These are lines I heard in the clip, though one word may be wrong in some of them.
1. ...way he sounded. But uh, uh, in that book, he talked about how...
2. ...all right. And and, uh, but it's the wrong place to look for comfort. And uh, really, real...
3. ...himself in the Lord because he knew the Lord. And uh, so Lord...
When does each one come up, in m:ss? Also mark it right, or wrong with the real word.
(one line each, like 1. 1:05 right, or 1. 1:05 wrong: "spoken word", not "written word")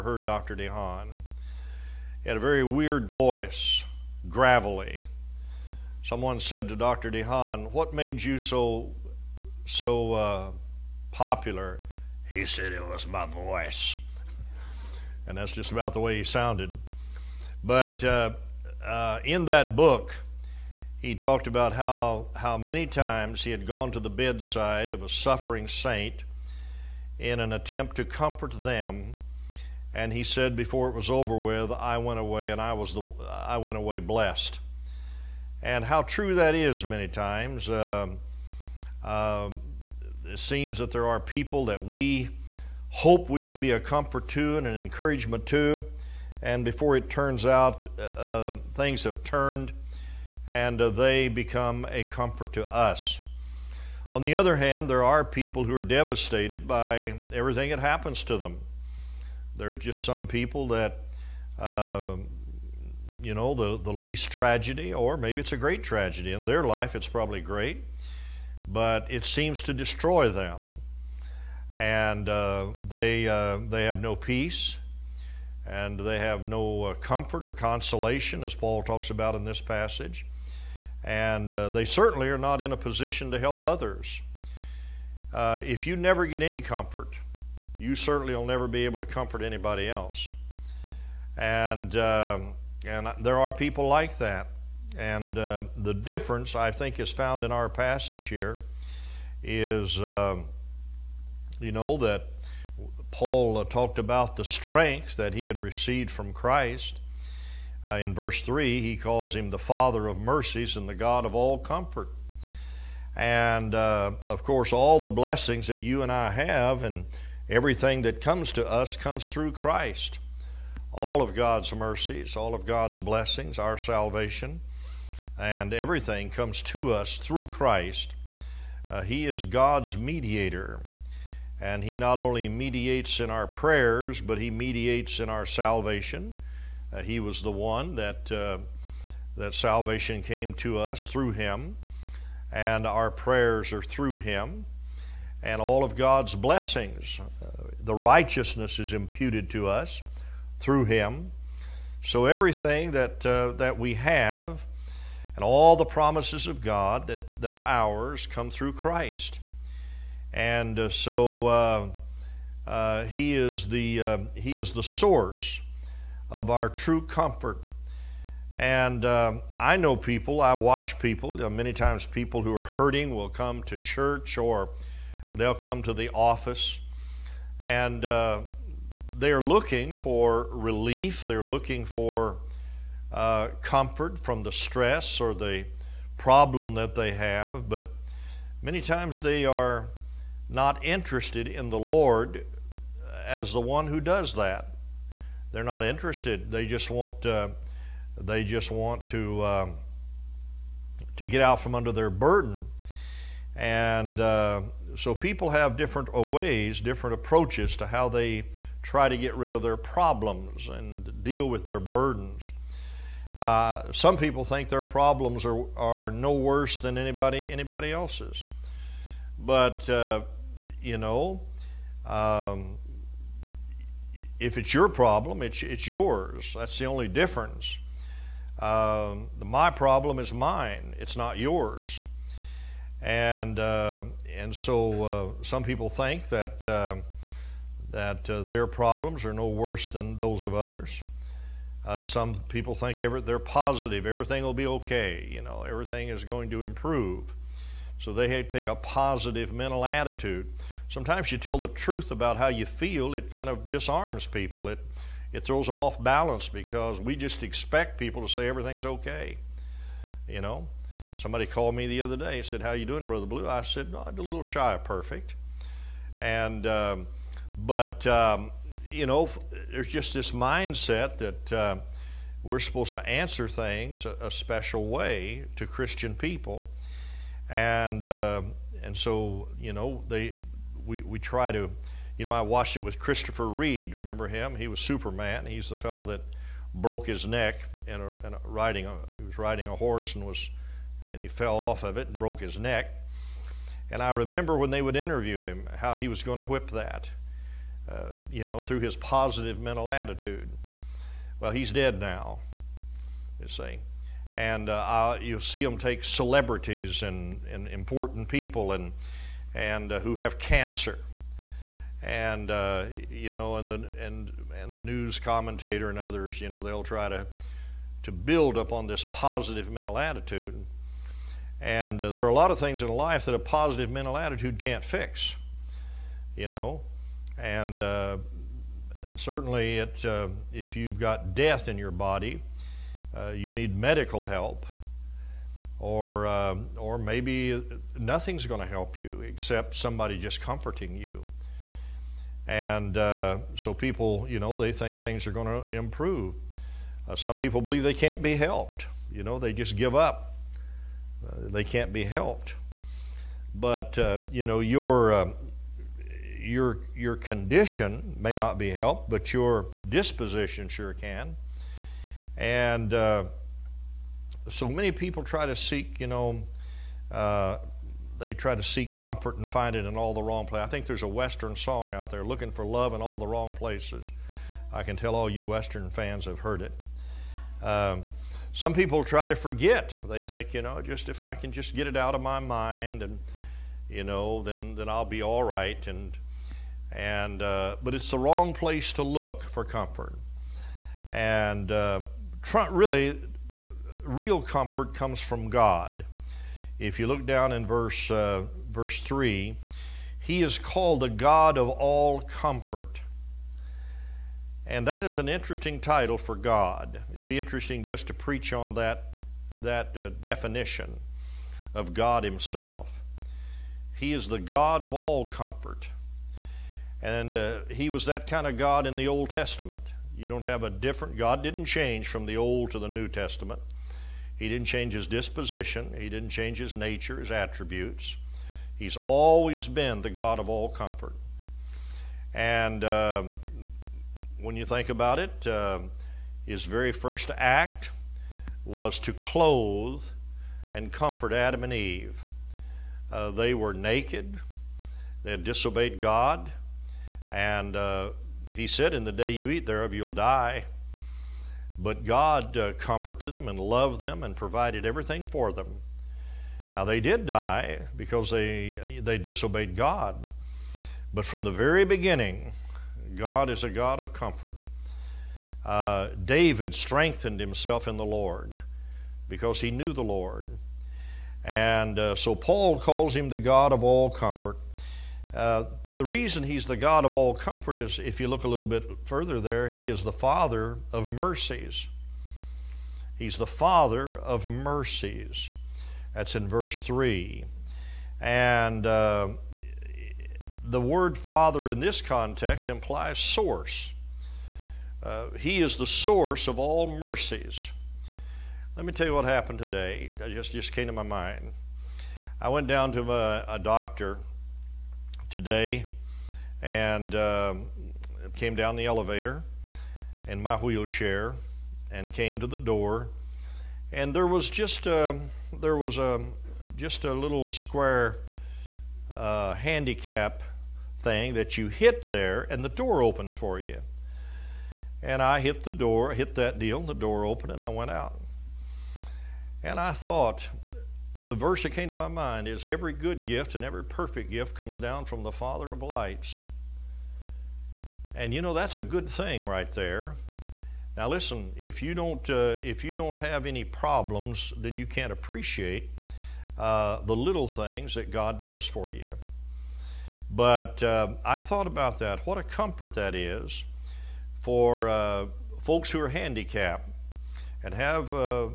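1. 0:15 right
2. 6:25 right
3. 7:47 wrong: "Paul", not "Lord".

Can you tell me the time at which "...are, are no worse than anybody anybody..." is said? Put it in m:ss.
3:35.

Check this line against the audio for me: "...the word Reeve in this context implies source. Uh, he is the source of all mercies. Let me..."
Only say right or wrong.
wrong.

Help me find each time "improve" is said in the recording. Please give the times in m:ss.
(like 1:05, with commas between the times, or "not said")
4:06, 5:45.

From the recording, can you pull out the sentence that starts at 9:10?
But uh, I thought about that.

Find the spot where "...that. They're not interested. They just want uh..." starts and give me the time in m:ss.
3:14.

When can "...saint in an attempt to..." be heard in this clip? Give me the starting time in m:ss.
0:25.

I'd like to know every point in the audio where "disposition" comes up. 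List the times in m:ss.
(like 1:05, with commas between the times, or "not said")
5:59, 7:05.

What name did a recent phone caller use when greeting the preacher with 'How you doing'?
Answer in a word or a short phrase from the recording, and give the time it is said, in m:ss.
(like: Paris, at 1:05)
Brother Blue, at 4:23.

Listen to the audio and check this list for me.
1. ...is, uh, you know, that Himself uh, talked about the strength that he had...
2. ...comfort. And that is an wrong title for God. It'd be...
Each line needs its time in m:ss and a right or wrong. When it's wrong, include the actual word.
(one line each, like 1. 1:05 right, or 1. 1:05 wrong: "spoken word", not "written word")
1. 1:39 wrong: "Paul", not "Himself"
2. 6:42 wrong: "interesting", not "wrong".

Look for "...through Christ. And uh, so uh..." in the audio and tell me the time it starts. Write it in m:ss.
2:38.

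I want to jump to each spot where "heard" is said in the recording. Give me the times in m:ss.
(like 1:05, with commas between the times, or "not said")
0:00, 6:16.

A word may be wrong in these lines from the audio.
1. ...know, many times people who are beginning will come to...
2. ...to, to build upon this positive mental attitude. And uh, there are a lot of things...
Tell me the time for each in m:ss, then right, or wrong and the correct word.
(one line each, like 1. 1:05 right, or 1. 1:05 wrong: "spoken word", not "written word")
1. 2:51 wrong: "hurting", not "beginning"
2. 5:17 right.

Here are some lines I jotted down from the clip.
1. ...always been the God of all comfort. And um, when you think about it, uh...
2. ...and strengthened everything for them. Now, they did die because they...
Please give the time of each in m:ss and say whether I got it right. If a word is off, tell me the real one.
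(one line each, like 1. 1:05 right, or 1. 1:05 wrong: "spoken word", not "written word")
1. 7:08 right
2. 7:34 wrong: "provided", not "strengthened".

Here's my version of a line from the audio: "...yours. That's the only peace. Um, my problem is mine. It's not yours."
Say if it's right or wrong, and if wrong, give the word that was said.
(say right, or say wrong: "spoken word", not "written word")
wrong: "difference", not "peace".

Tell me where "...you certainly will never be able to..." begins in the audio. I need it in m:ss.
1:27.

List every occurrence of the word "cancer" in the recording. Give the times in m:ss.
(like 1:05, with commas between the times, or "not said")
5:10.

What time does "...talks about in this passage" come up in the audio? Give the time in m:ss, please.
1:18.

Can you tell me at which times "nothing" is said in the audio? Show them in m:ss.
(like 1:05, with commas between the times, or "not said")
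5:37.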